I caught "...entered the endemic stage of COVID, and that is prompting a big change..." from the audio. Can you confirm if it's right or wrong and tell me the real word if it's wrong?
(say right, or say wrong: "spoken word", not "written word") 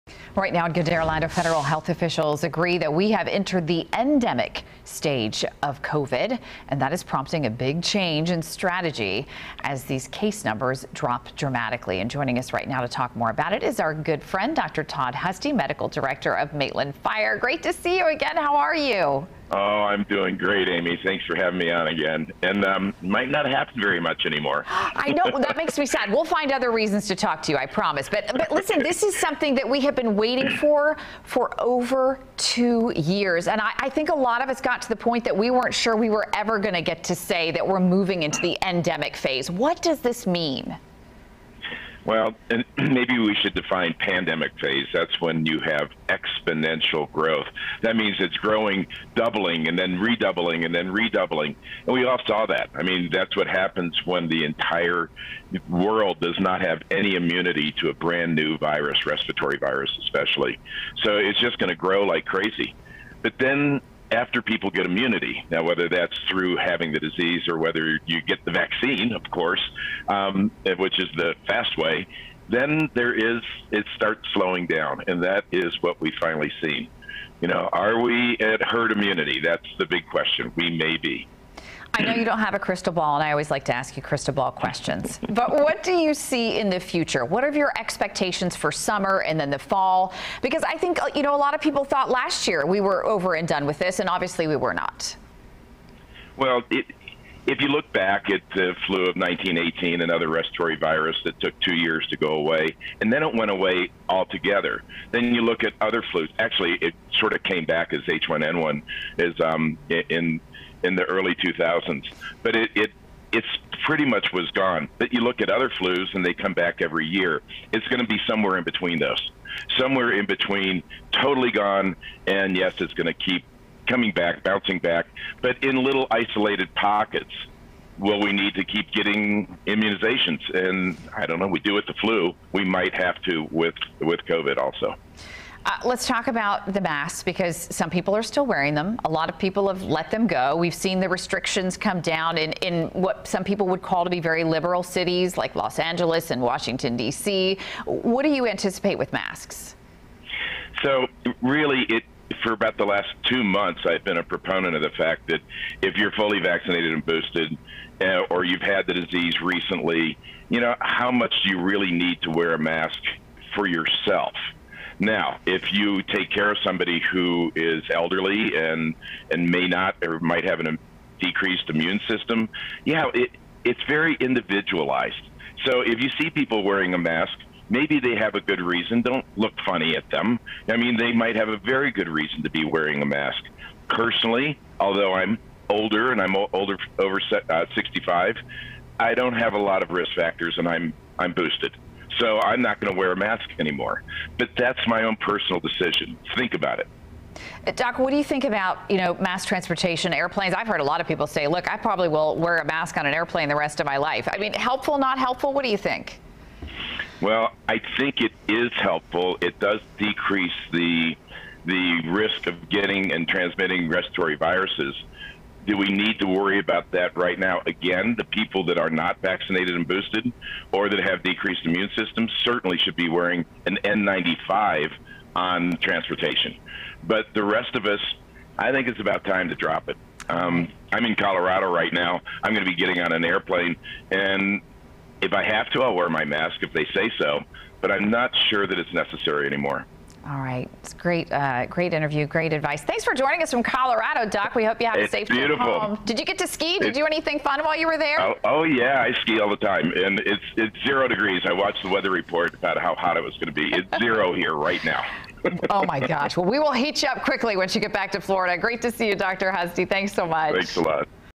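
right.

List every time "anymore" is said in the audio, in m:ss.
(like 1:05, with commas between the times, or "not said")
0:24, 3:13, 3:59.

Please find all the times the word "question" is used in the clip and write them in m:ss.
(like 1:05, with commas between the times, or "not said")
1:20, 1:24.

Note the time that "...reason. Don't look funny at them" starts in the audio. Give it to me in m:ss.
2:58.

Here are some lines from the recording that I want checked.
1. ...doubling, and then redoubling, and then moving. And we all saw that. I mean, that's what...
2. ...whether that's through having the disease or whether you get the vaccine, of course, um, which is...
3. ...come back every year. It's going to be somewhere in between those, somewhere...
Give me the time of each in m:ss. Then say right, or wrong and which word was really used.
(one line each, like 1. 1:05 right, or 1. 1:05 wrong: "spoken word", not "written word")
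1. 0:49 wrong: "redoubling", not "moving"
2. 1:05 right
3. 1:56 right.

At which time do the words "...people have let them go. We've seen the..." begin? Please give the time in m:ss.
2:19.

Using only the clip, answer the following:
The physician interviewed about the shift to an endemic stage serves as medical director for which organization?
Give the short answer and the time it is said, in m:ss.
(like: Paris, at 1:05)
Maitland Fire, at 0:16.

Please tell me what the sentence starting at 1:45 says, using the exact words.
Then you look at other flus.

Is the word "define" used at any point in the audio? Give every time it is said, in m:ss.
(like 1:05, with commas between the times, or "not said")
0:43.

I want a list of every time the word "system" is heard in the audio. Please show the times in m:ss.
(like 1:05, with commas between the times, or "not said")
2:52, 3:41.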